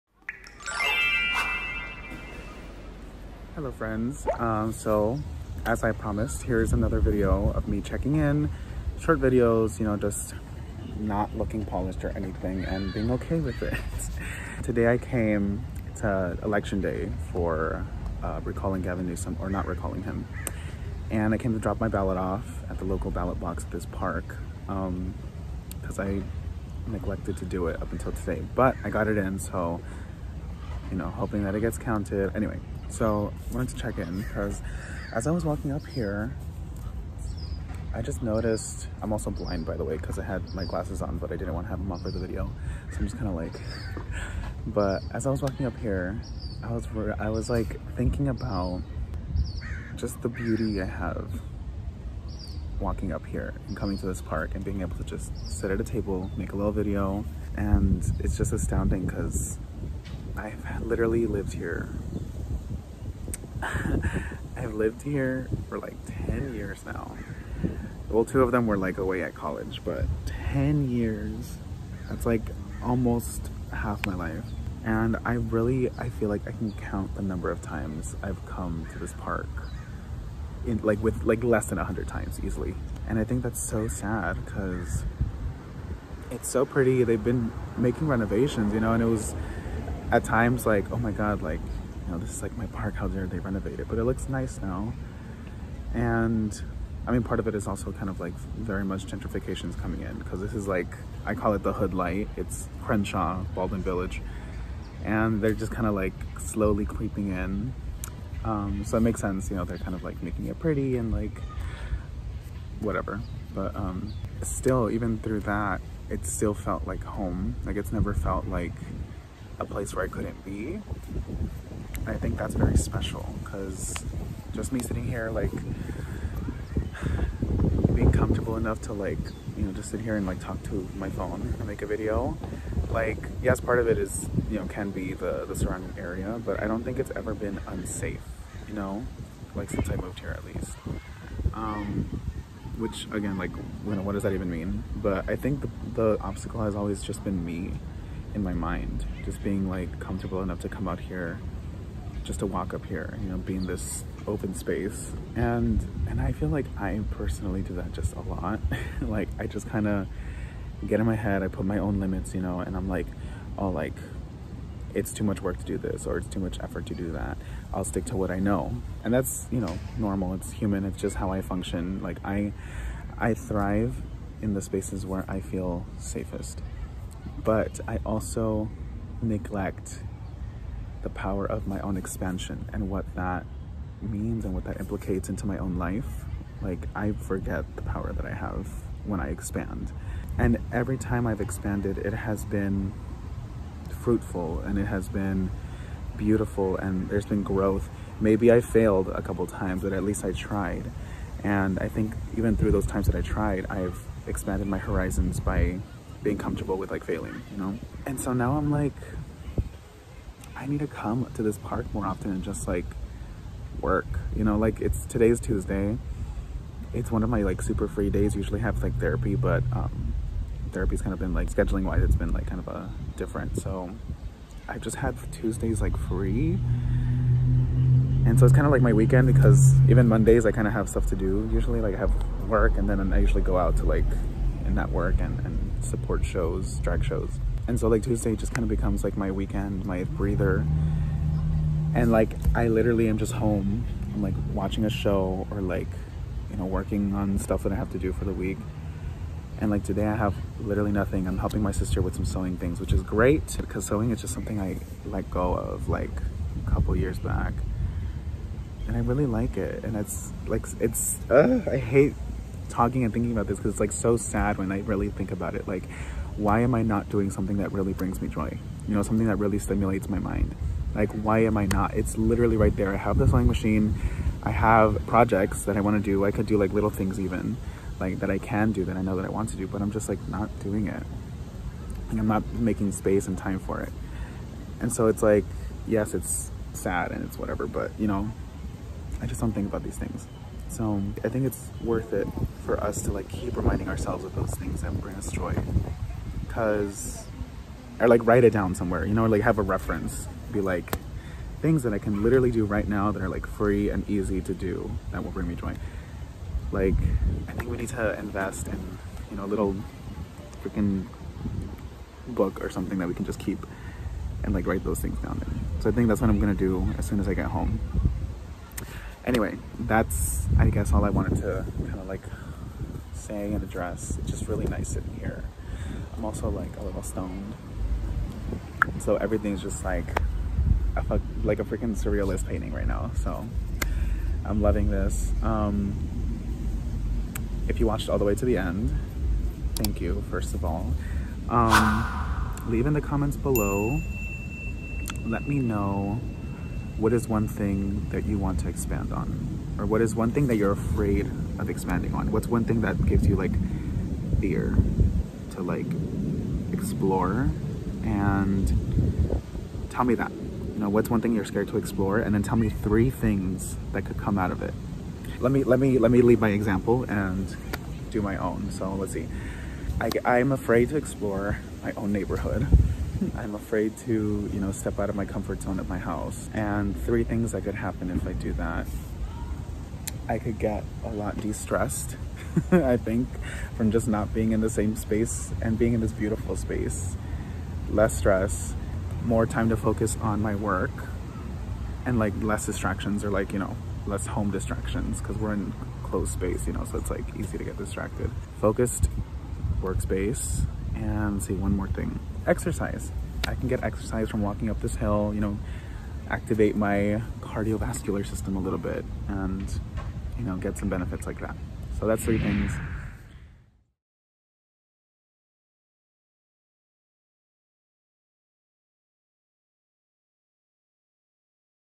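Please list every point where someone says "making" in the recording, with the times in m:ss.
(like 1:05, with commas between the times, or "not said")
1:27, 1:50, 4:42.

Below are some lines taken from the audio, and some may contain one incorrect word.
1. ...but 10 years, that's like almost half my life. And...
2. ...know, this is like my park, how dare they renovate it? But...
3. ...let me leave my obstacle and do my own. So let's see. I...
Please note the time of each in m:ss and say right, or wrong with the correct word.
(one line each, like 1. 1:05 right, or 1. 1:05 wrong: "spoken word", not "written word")
1. 1:09 right
2. 1:32 right
3. 6:05 wrong: "example", not "obstacle".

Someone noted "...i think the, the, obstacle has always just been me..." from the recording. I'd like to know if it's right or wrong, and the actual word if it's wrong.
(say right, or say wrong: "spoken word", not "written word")
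right.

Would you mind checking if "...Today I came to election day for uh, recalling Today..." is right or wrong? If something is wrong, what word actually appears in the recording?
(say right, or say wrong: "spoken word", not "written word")
wrong: "Gavin", not "Today".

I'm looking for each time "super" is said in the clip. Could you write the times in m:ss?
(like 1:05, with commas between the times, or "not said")
3:37.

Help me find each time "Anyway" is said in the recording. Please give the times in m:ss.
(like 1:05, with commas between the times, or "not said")
0:32, 5:19.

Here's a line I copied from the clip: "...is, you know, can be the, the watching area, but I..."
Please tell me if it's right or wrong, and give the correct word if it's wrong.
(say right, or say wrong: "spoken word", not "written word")
wrong: "surrounding", not "watching".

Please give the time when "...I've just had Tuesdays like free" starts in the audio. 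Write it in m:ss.
3:44.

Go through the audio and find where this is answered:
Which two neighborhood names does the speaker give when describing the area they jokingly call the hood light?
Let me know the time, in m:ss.
1:42.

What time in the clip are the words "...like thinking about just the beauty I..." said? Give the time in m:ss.
0:47.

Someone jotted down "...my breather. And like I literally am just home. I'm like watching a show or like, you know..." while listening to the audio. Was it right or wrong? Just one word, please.
right.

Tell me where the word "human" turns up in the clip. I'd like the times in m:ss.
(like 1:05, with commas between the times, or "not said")
2:50.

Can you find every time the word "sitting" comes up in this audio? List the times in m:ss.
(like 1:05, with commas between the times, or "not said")
2:04, 5:24.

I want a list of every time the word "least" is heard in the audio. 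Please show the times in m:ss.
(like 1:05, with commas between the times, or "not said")
2:20, 3:20.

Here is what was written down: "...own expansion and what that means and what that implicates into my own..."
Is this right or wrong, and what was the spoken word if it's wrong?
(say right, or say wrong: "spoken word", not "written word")
right.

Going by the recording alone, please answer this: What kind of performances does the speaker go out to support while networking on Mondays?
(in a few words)
Drag shows.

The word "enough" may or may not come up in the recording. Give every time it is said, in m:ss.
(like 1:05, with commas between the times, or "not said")
2:08, 2:30.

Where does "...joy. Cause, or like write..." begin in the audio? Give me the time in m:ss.
4:55.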